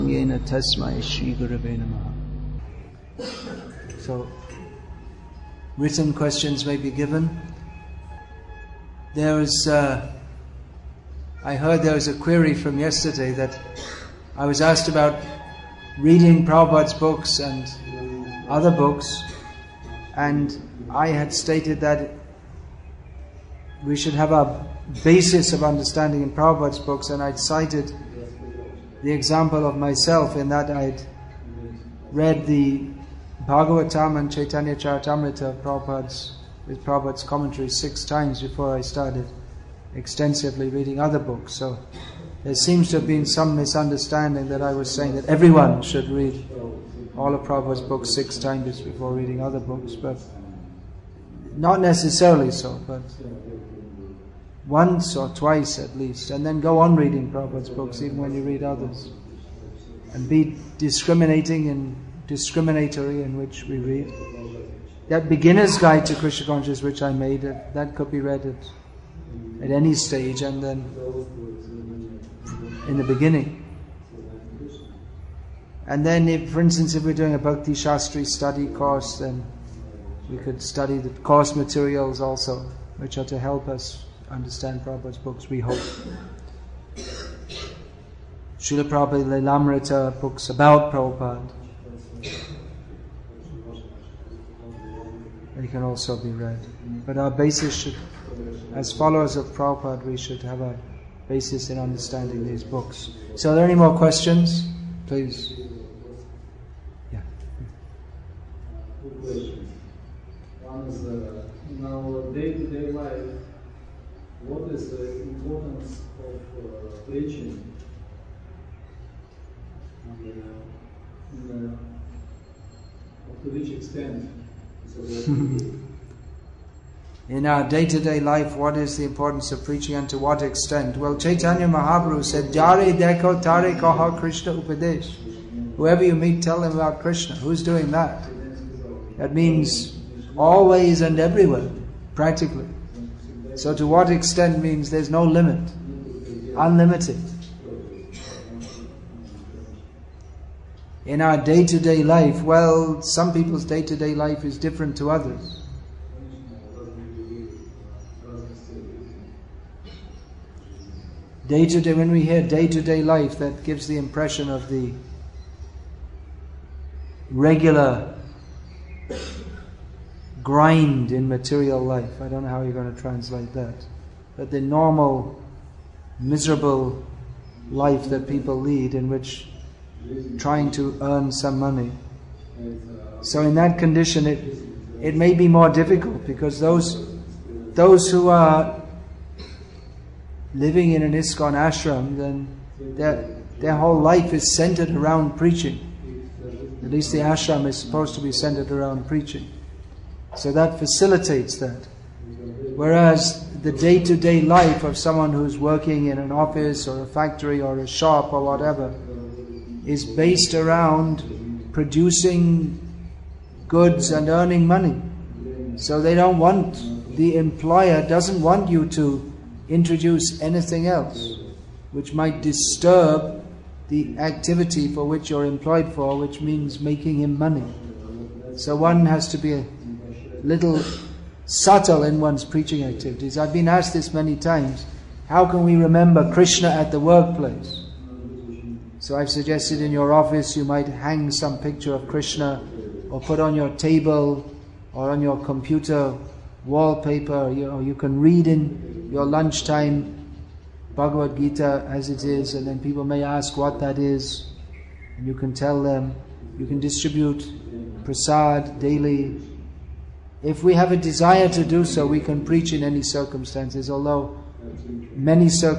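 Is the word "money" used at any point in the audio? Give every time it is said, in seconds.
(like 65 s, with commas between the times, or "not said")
181 s, 214 s, 227 s.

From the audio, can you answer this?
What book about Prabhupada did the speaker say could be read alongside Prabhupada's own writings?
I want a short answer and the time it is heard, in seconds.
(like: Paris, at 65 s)
Srila Prabhupada Lilamrita, at 88 s.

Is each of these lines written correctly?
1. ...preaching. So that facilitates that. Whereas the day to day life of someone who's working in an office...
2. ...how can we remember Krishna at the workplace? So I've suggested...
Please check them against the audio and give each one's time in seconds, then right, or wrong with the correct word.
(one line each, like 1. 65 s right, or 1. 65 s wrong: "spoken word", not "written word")
1. 199 s right
2. 235 s right.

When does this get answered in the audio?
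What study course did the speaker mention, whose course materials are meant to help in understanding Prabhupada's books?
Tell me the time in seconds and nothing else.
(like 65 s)
77 s.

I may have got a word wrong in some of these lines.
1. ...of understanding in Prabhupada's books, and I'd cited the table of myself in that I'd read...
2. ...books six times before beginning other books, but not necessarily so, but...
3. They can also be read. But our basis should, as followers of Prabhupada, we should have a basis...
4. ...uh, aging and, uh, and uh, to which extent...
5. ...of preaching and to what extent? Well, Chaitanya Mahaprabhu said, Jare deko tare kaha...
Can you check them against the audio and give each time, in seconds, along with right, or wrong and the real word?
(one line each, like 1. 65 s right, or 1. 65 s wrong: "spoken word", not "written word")
1. 25 s wrong: "example", not "table"
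2. 47 s wrong: "reading", not "beginning"
3. 95 s right
4. 116 s right
5. 129 s right.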